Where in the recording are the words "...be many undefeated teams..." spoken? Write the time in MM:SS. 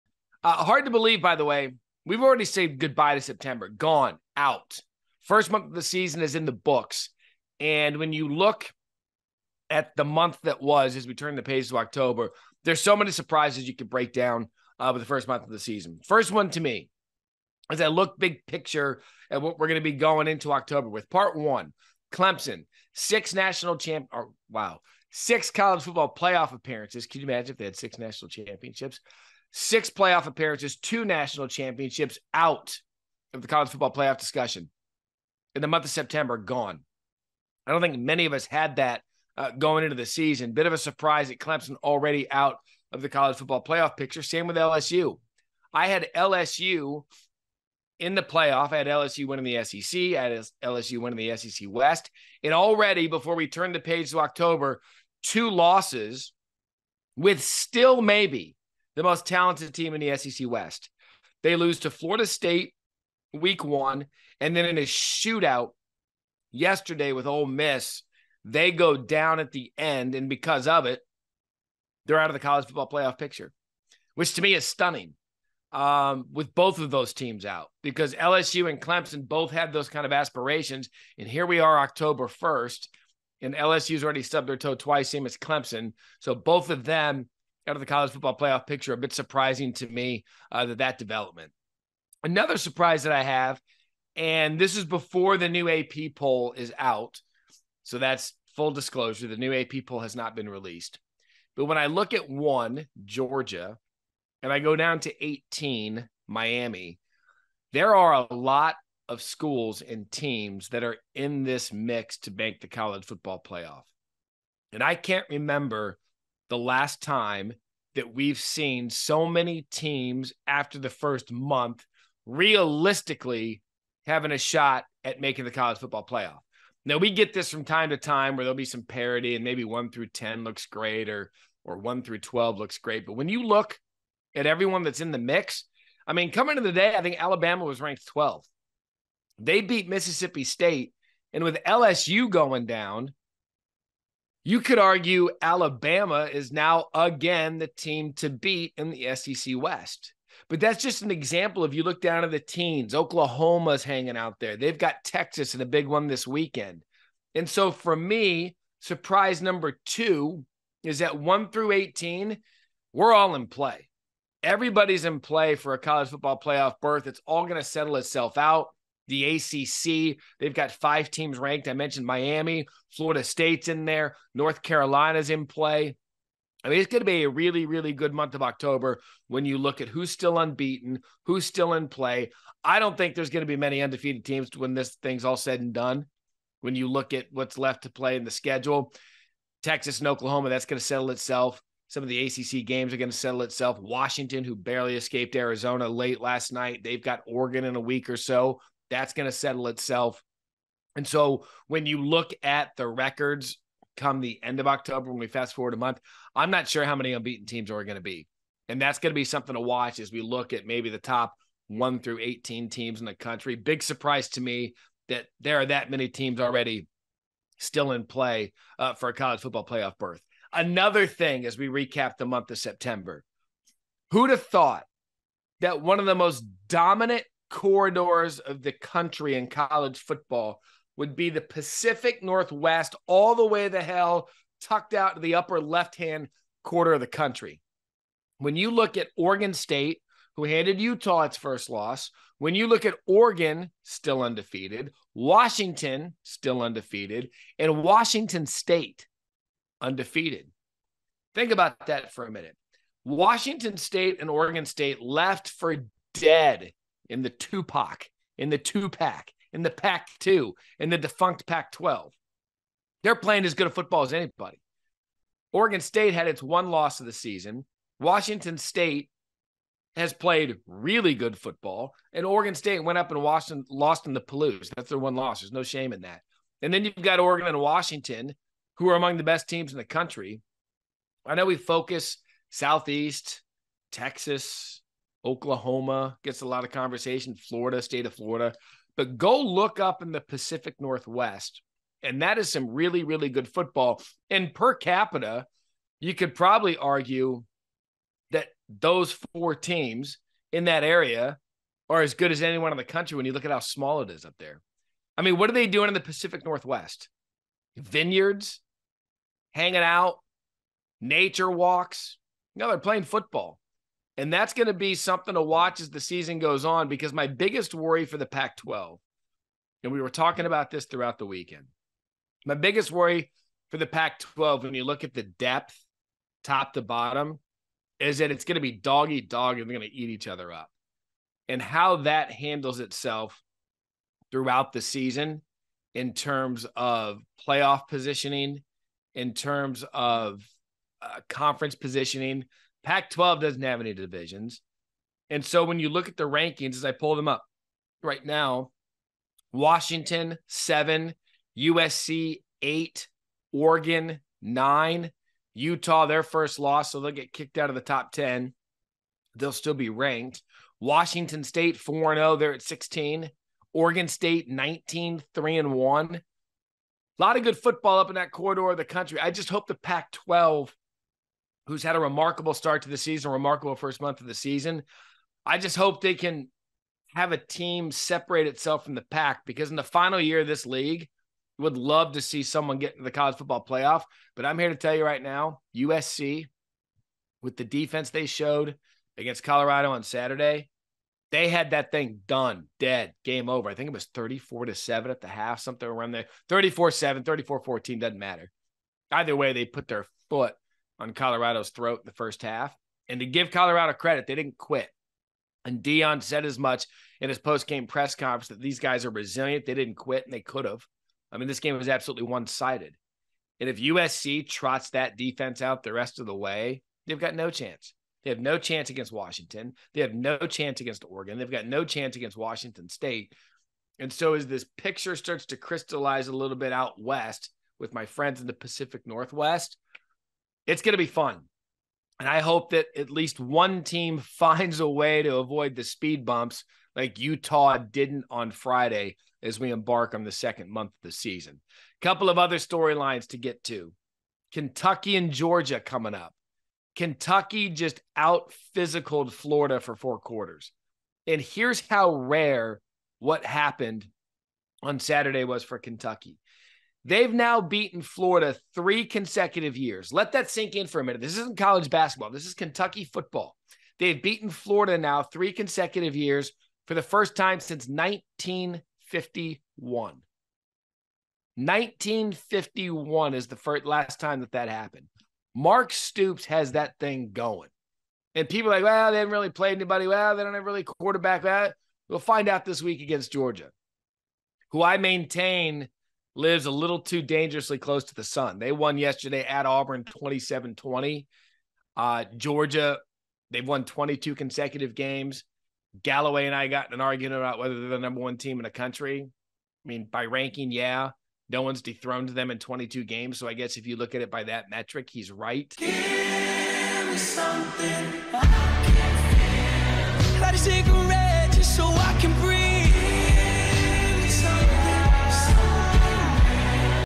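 03:03.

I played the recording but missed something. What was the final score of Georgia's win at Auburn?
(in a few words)
27-20.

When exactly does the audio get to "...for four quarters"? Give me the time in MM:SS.
07:29.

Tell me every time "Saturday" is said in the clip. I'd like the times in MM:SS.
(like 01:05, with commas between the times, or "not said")
06:30, 07:34.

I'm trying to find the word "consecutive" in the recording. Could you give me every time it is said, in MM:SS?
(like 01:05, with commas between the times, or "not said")
07:39, 07:45, 08:14.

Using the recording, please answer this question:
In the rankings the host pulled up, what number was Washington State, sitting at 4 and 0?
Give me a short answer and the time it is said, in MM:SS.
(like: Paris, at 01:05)
16, at 06:02.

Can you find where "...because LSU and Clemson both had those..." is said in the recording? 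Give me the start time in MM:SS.
01:17.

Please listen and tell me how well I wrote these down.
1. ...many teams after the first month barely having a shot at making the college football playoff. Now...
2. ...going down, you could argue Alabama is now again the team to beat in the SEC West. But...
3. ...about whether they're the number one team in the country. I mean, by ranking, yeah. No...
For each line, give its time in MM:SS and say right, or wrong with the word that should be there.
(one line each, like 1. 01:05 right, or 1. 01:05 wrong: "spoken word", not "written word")
1. 01:59 wrong: "realistically", not "barely"
2. 02:22 right
3. 08:17 right.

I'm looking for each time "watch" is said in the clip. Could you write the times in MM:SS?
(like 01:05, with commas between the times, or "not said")
03:29, 05:15.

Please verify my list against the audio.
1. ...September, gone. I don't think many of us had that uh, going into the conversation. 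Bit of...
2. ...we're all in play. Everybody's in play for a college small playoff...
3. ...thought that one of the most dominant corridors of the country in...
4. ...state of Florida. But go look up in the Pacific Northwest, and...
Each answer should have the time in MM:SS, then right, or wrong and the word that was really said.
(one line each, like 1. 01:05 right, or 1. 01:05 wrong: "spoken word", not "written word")
1. 00:35 wrong: "season", not "conversation"
2. 02:42 wrong: "football", not "small"
3. 03:44 right
4. 04:47 right.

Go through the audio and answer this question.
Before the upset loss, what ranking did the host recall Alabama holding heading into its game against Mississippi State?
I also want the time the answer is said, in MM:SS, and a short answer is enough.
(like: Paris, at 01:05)
12th, at 02:18.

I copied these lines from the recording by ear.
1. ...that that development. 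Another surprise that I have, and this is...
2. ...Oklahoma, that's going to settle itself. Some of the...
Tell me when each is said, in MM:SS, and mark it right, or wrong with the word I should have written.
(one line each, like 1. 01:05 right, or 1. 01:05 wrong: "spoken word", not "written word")
1. 01:30 right
2. 03:10 right.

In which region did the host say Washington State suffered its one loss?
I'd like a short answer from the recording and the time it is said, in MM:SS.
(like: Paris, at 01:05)
the Palouse, at 04:34.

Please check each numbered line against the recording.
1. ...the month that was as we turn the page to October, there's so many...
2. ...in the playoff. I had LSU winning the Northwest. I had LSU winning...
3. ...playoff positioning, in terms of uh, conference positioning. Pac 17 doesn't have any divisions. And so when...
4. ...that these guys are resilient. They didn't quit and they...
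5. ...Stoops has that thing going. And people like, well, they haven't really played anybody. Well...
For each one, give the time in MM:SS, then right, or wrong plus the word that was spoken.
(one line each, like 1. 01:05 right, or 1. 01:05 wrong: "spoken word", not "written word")
1. 00:09 right
2. 00:47 wrong: "SEC", not "Northwest"
3. 05:37 wrong: "12", not "17"
4. 06:48 right
5. 07:55 right.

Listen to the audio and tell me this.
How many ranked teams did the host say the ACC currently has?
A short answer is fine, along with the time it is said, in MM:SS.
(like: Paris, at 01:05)
5, at 02:50.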